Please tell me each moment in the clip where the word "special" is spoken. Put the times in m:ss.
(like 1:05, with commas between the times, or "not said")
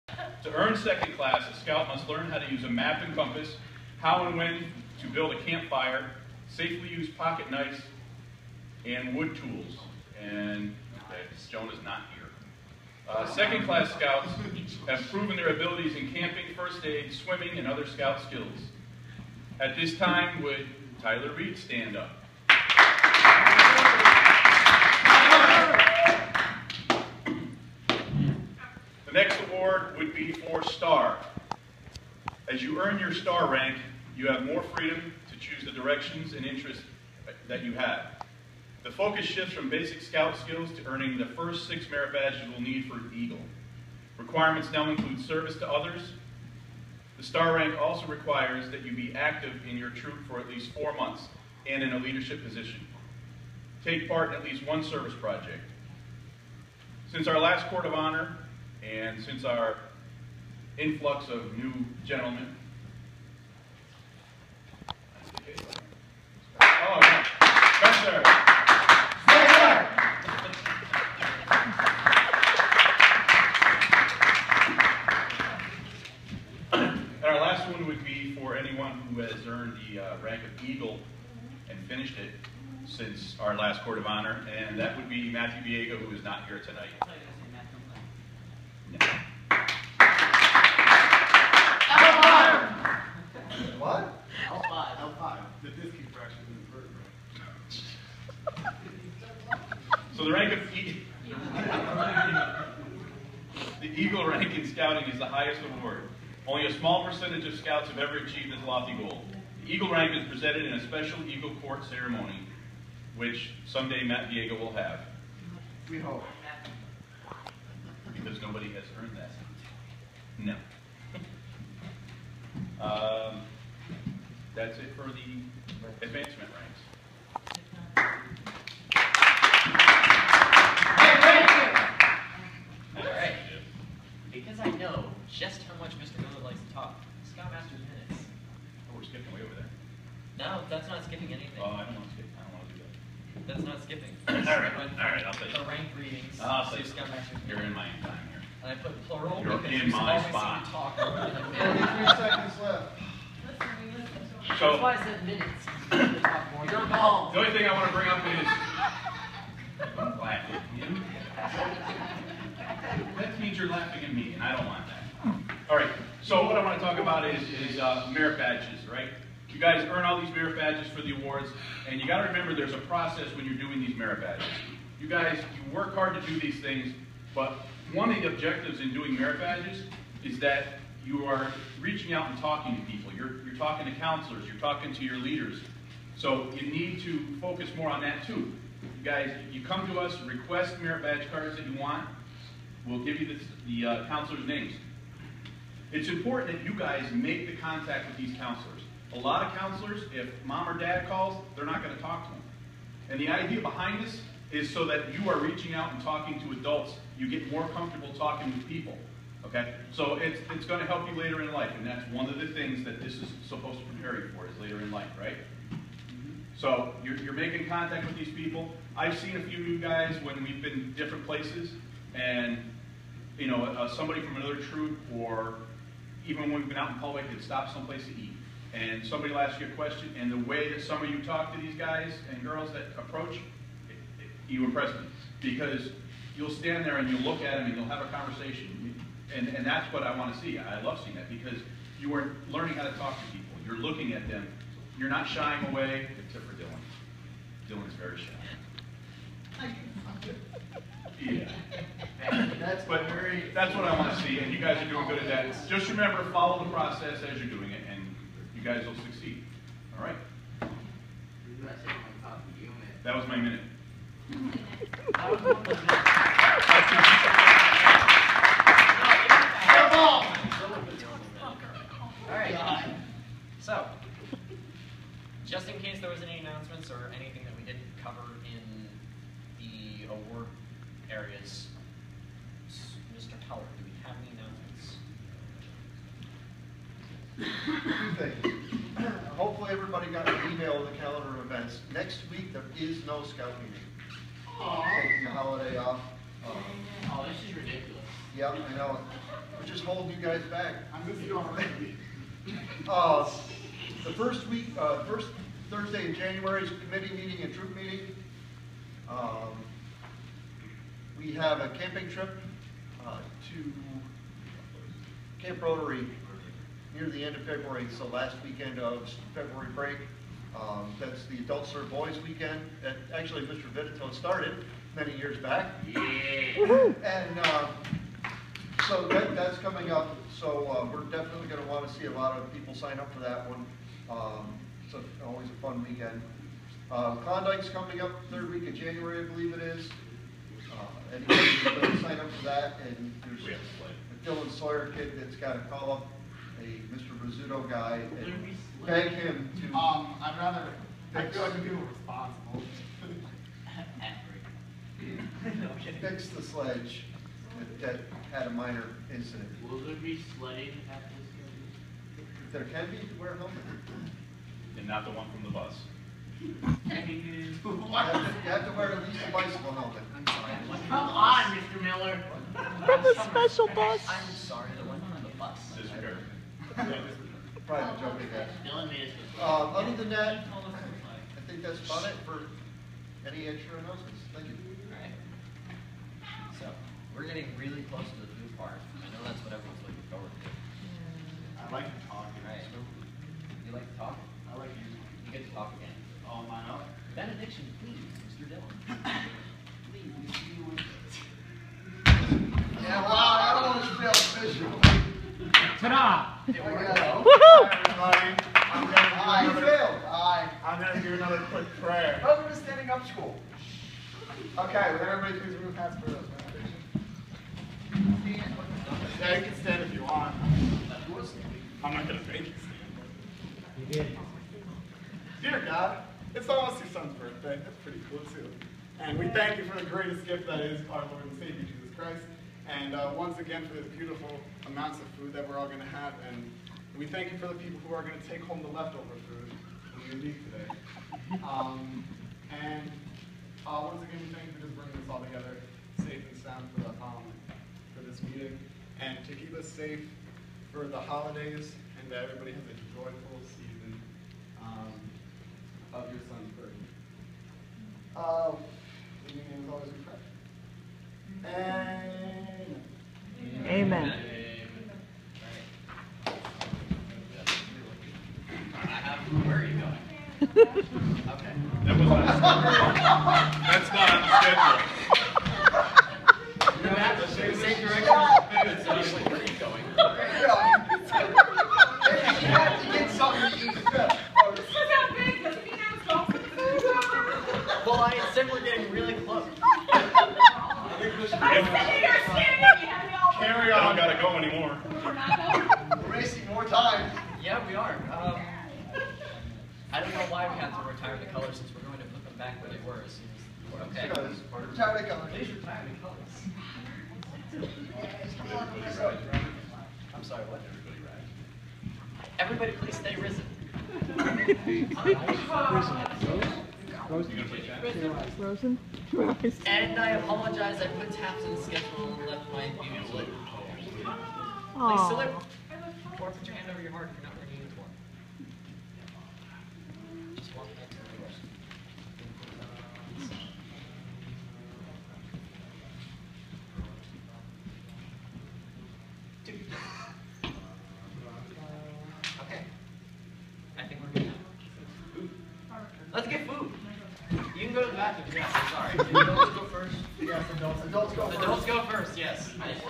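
1:50, 6:13.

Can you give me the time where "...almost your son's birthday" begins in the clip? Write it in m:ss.
7:06.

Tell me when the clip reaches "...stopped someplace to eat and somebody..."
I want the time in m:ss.
3:47.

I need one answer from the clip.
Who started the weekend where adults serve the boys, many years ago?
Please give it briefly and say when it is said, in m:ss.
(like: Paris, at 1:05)
Mr. Vitito, at 5:23.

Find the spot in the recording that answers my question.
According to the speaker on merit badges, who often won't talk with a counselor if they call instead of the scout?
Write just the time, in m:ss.
3:20.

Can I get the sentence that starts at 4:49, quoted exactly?
Hopefully everybody got an email of the calendar of events.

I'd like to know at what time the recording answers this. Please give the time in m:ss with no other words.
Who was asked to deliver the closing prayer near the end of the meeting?
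6:38.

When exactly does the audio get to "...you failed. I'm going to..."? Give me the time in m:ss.
6:49.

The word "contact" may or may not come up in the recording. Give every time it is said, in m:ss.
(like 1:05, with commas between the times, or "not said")
3:17, 3:37.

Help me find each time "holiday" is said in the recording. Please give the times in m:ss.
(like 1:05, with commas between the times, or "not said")
4:55, 7:30.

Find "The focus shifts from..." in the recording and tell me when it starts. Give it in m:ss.
0:38.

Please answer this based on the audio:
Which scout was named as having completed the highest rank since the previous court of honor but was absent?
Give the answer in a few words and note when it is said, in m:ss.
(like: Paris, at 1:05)
Matthew Biega, at 1:25.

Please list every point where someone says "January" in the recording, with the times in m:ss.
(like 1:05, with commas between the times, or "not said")
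5:06, 5:38.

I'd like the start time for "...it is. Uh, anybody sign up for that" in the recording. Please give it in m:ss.
5:39.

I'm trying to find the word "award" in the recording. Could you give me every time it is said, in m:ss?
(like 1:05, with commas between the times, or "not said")
1:45, 2:51, 4:40.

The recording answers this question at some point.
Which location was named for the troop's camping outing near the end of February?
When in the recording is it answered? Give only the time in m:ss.
5:15.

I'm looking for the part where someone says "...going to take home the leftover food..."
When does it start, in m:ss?
7:18.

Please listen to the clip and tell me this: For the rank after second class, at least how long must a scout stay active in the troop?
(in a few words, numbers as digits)
4 months.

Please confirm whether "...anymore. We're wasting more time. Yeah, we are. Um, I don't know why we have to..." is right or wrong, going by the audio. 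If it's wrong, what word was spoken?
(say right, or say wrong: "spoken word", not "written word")
right.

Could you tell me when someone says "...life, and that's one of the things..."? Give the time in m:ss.
3:31.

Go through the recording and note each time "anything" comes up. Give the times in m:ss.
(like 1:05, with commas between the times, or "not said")
2:21, 4:37.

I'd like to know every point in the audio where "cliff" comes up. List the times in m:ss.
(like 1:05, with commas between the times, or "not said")
not said.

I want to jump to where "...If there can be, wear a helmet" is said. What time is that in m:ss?
6:02.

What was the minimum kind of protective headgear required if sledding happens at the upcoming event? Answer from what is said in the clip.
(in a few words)
Bicycle helmet.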